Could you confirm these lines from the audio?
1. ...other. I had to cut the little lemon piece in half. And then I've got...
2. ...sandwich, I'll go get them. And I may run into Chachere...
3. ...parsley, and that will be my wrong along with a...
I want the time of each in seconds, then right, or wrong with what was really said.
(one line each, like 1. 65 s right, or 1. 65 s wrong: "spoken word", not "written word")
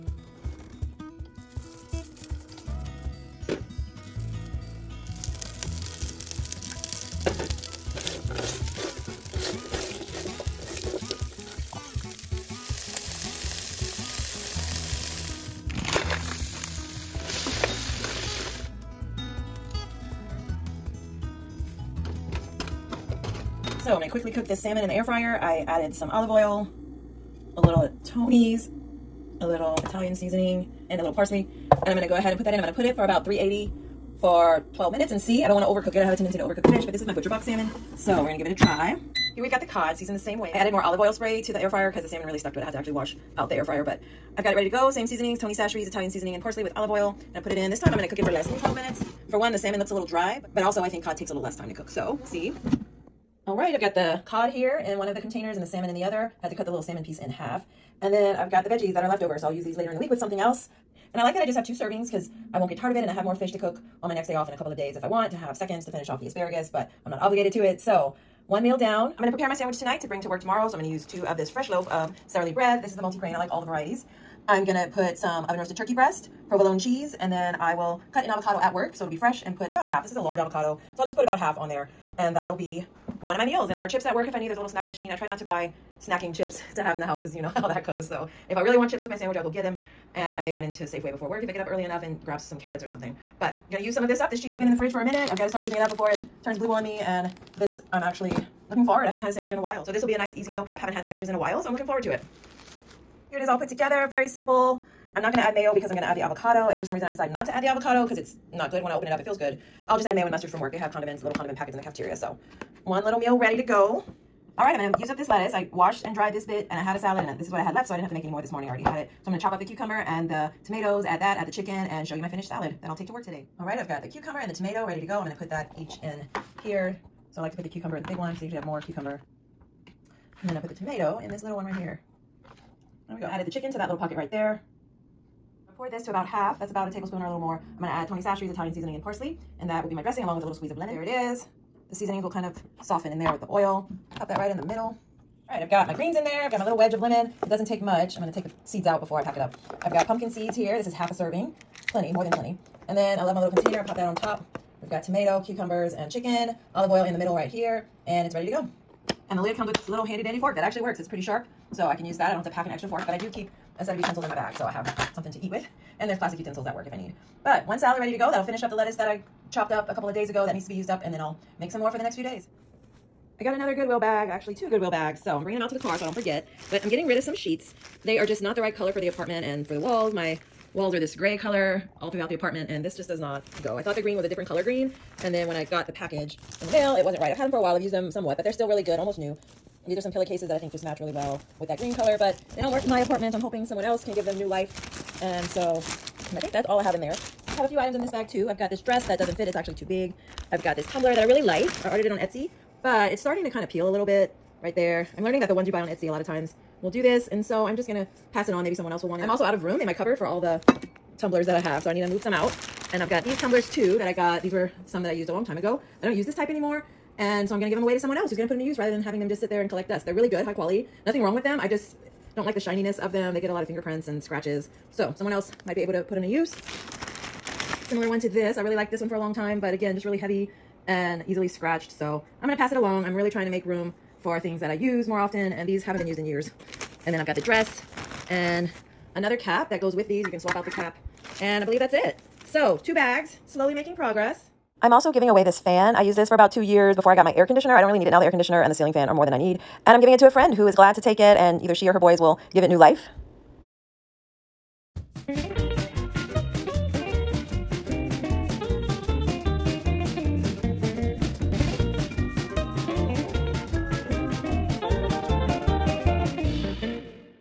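1. 56 s wrong: "salmon", not "lemon"
2. 89 s wrong: "Safeway", not "Chachere"
3. 139 s wrong: "dressing", not "wrong".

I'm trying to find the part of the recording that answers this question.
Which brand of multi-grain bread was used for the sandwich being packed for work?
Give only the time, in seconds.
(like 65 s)
72 s.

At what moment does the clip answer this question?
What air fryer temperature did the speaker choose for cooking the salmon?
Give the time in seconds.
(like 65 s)
33 s.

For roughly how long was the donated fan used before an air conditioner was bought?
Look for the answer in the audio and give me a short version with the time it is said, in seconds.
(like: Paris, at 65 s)
About 2 years, at 246 s.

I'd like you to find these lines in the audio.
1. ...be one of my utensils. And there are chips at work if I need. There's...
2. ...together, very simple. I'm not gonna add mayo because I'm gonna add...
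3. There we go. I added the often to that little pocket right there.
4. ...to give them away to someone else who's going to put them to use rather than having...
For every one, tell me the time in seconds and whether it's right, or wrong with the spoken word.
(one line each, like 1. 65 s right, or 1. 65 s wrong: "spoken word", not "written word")
1. 82 s wrong: "meals", not "utensils"
2. 103 s right
3. 133 s wrong: "chicken", not "often"
4. 217 s right.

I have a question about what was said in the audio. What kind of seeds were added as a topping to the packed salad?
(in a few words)
Pumpkin seeds.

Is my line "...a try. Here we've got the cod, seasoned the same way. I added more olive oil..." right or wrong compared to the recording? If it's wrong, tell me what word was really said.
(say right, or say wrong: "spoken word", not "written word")
right.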